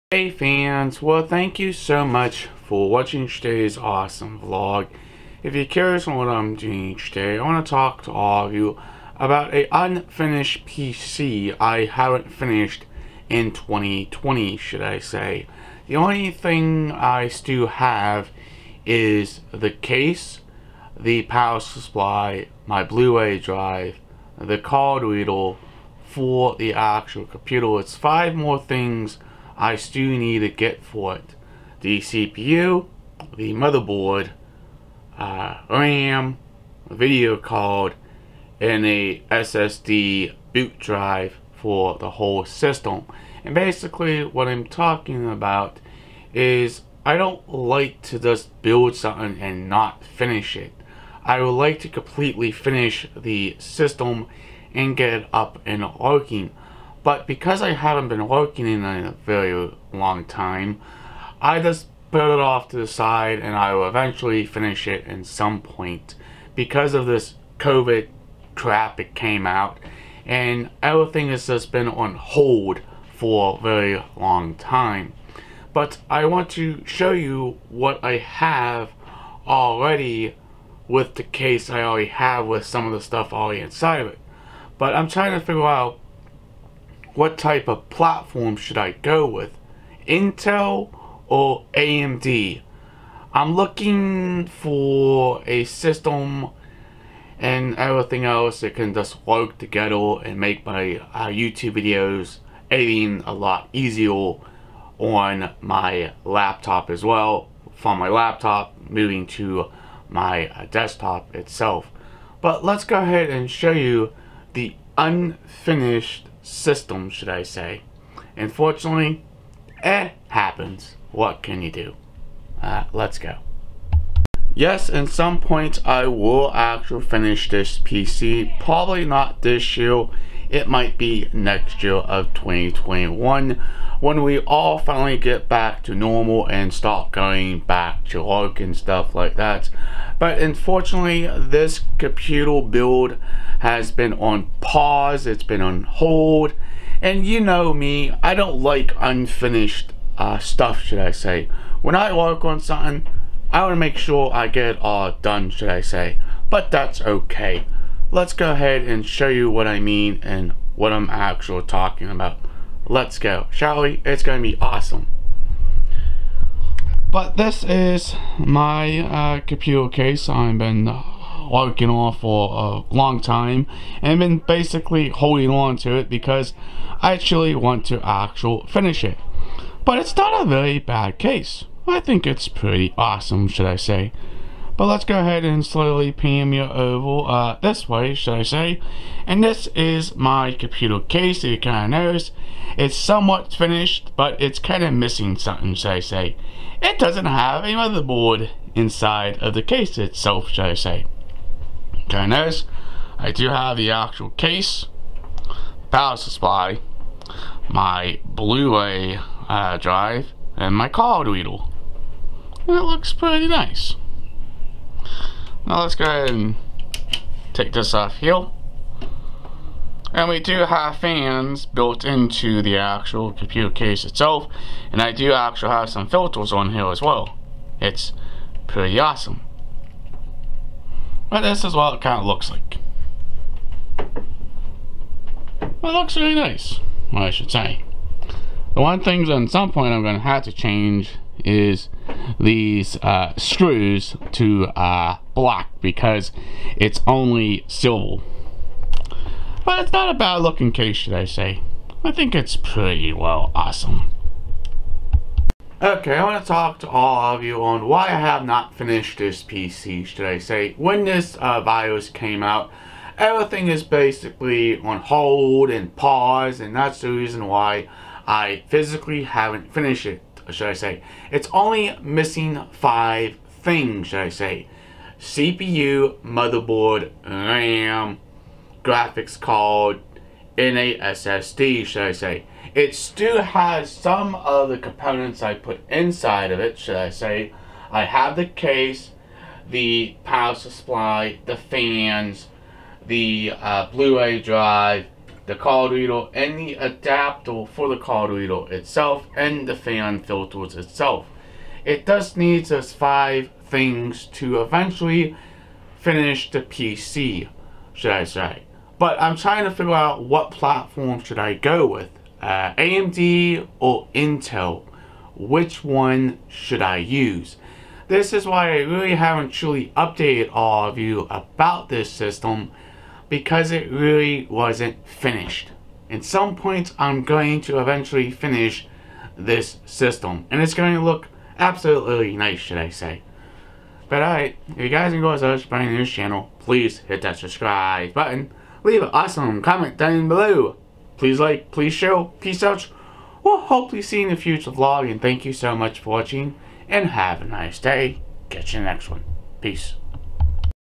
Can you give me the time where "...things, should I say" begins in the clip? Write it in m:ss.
4:33.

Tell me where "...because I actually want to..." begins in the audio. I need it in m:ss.
2:56.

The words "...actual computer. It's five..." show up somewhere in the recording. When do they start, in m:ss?
0:26.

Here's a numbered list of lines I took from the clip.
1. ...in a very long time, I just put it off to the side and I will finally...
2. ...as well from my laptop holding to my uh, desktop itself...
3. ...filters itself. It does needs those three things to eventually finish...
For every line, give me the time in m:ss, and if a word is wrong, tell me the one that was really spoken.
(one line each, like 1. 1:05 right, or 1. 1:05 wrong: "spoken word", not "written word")
1. 0:58 wrong: "eventually", not "finally"
2. 1:46 wrong: "moving", not "holding"
3. 5:00 wrong: "five", not "three".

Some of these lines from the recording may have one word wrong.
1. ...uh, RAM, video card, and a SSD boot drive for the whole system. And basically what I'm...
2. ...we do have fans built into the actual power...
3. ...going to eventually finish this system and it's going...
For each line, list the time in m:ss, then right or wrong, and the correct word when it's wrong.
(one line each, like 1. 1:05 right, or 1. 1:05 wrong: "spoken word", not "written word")
1. 0:35 right
2. 3:40 wrong: "computer", not "power"
3. 5:27 right.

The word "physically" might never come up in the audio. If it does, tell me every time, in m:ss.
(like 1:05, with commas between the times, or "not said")
4:28.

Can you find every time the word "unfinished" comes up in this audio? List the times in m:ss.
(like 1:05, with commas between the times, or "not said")
0:09, 1:54, 2:28.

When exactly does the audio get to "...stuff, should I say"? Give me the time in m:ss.
2:30.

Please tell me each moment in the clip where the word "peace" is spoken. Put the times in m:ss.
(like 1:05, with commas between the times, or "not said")
5:42, 5:49.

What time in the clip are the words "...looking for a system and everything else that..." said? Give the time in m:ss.
1:33.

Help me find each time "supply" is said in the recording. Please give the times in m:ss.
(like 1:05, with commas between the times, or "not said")
0:21, 3:26, 4:50.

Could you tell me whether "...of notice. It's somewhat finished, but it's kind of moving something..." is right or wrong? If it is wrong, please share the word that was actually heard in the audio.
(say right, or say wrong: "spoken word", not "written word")
wrong: "missing", not "moving".